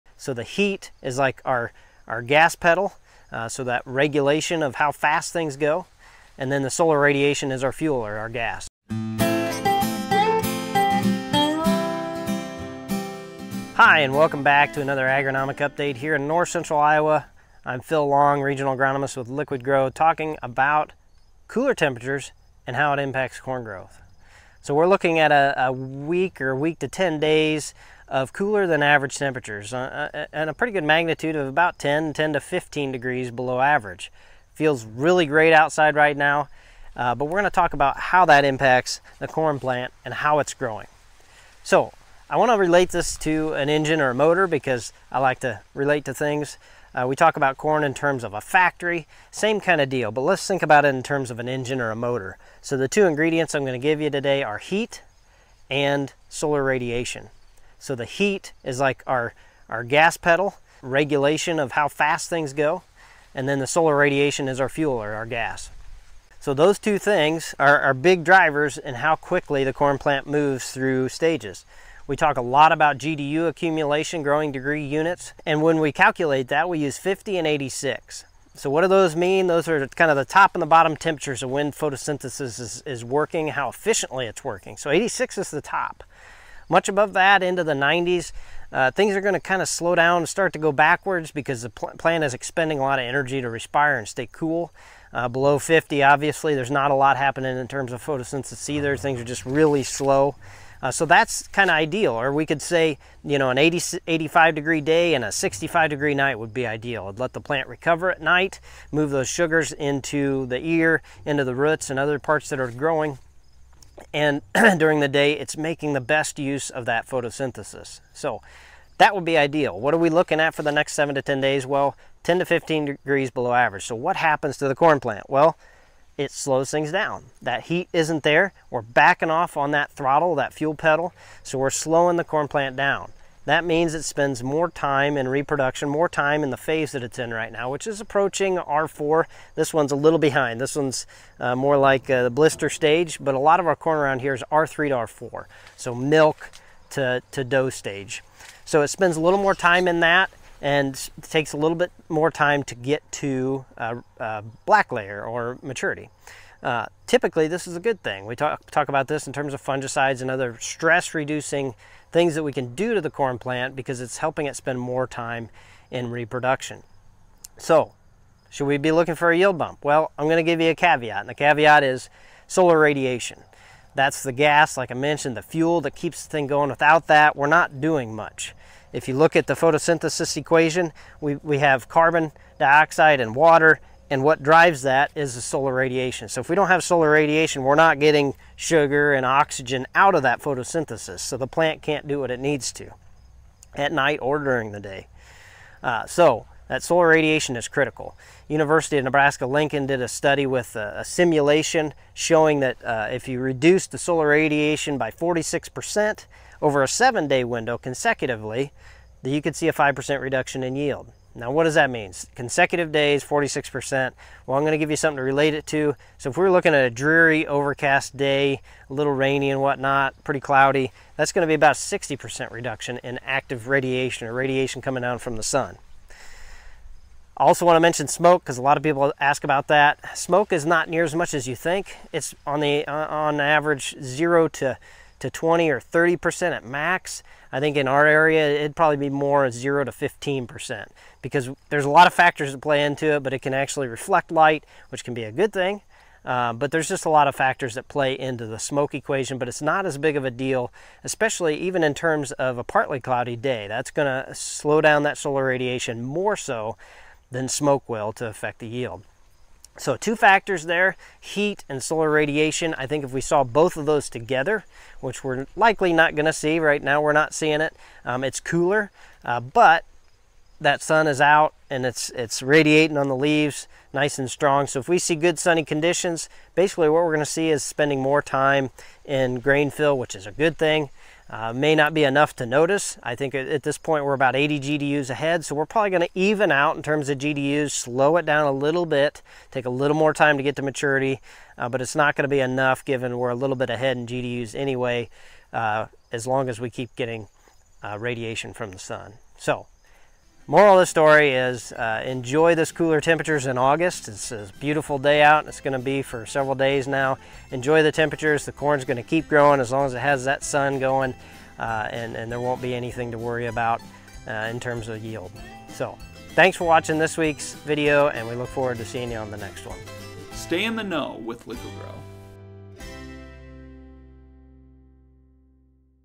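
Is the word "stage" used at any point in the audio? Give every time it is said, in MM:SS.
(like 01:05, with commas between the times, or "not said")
01:11, 02:22, 02:27.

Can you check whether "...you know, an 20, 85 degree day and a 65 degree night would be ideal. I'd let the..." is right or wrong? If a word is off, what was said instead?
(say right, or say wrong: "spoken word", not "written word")
wrong: "80", not "20".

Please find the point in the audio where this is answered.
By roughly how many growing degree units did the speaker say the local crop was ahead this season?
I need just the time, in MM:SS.
04:44.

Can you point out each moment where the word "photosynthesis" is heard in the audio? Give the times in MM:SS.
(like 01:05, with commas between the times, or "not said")
01:21, 01:38, 01:57, 02:59, 03:10.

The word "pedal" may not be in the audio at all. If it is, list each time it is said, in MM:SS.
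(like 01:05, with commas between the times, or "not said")
00:02, 01:00, 02:10.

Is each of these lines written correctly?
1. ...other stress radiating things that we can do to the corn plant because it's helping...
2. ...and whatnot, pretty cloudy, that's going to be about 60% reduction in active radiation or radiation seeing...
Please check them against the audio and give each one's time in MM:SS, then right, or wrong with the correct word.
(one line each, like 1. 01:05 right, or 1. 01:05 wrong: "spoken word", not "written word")
1. 02:40 wrong: "reducing", not "radiating"
2. 03:39 wrong: "coming", not "seeing".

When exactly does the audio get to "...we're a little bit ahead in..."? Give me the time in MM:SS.
04:53.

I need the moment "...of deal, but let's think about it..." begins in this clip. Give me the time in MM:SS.
00:49.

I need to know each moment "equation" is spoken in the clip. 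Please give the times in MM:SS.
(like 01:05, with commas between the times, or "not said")
03:00, 04:08.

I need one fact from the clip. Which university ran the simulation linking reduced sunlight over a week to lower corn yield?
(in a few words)
University of Nebraska-Lincoln.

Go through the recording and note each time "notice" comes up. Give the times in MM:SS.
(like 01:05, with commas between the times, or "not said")
04:42.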